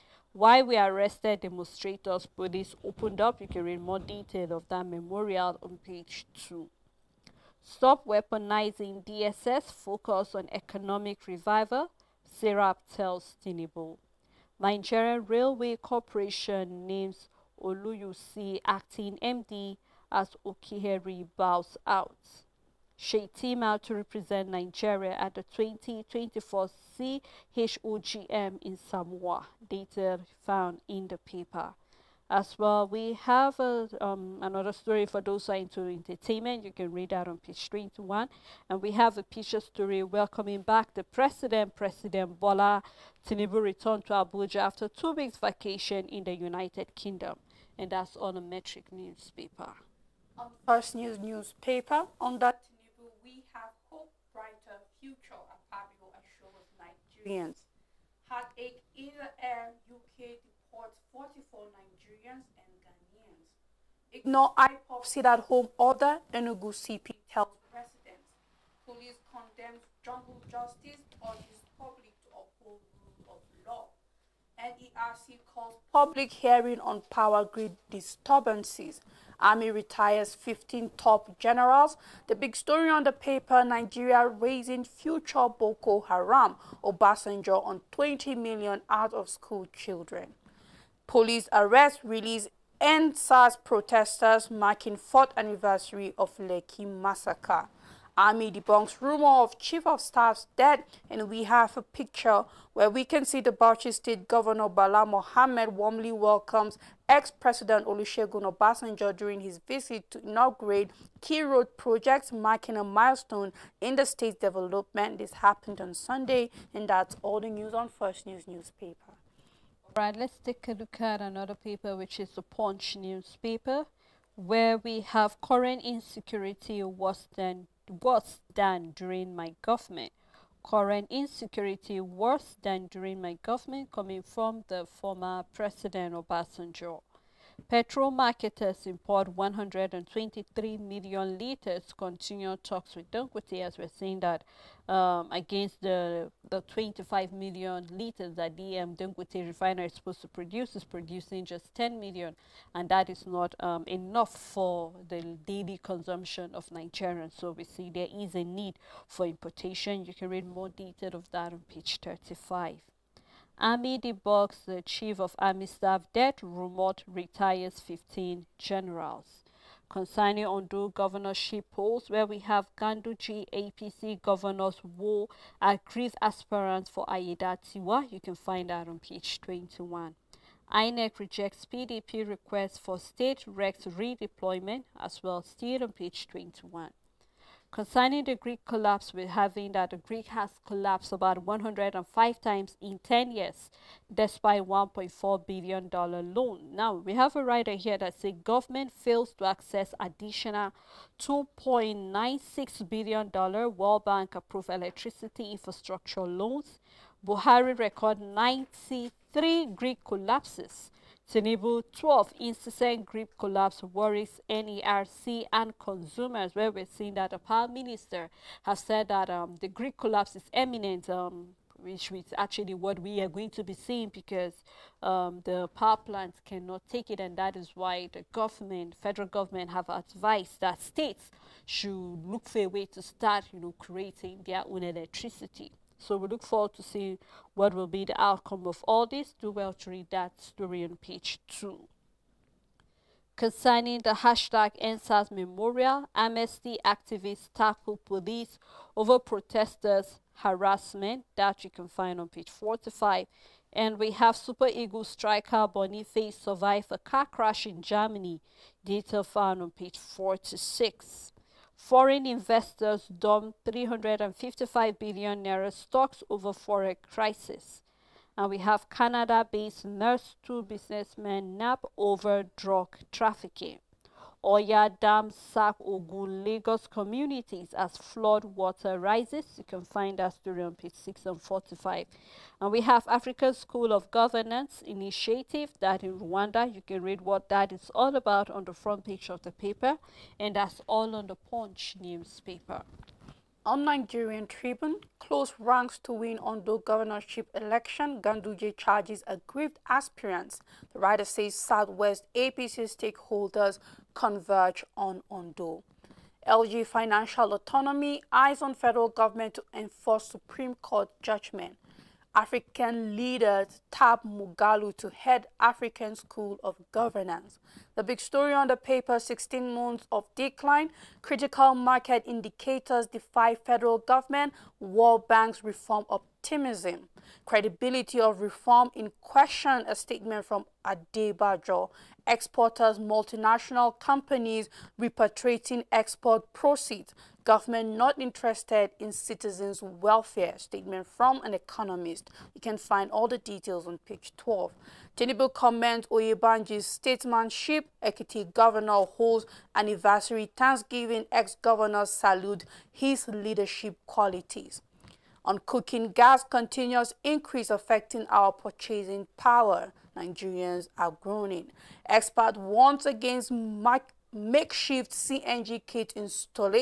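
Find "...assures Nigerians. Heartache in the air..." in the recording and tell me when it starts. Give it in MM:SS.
00:56.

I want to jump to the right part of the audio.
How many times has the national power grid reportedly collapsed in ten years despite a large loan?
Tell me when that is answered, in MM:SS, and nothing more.
03:11.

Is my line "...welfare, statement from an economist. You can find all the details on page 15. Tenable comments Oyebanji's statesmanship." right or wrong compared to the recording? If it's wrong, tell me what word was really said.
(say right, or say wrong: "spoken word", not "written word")
wrong: "12", not "15".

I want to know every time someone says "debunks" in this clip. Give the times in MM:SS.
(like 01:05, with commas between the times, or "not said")
01:38, 02:43.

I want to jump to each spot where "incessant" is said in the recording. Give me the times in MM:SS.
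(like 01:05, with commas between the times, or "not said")
03:32.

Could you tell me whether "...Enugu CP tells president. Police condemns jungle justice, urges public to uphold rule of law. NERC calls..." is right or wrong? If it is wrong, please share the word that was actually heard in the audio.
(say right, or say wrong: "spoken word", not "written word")
right.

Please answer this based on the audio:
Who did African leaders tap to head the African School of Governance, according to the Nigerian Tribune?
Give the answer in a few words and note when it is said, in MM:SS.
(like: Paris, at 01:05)
Moghalu, at 05:14.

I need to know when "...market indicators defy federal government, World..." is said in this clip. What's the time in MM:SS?
05:21.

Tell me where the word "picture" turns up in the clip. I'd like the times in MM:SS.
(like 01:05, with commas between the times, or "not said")
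00:39, 01:41.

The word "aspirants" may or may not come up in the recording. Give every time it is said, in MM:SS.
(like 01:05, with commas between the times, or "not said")
02:56, 04:59.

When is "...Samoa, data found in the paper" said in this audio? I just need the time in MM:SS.
00:28.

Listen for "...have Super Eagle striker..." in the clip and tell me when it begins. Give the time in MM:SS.
04:14.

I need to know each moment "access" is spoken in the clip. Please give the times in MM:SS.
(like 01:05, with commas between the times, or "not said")
03:19.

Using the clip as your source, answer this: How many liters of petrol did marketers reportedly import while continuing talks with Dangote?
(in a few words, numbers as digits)
123 million liters.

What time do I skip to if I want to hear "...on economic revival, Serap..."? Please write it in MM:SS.
00:10.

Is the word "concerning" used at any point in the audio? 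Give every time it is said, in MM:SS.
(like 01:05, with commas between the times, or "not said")
02:49, 03:07, 04:03.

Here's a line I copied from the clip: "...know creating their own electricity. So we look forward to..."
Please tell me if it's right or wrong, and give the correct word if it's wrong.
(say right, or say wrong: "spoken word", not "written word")
right.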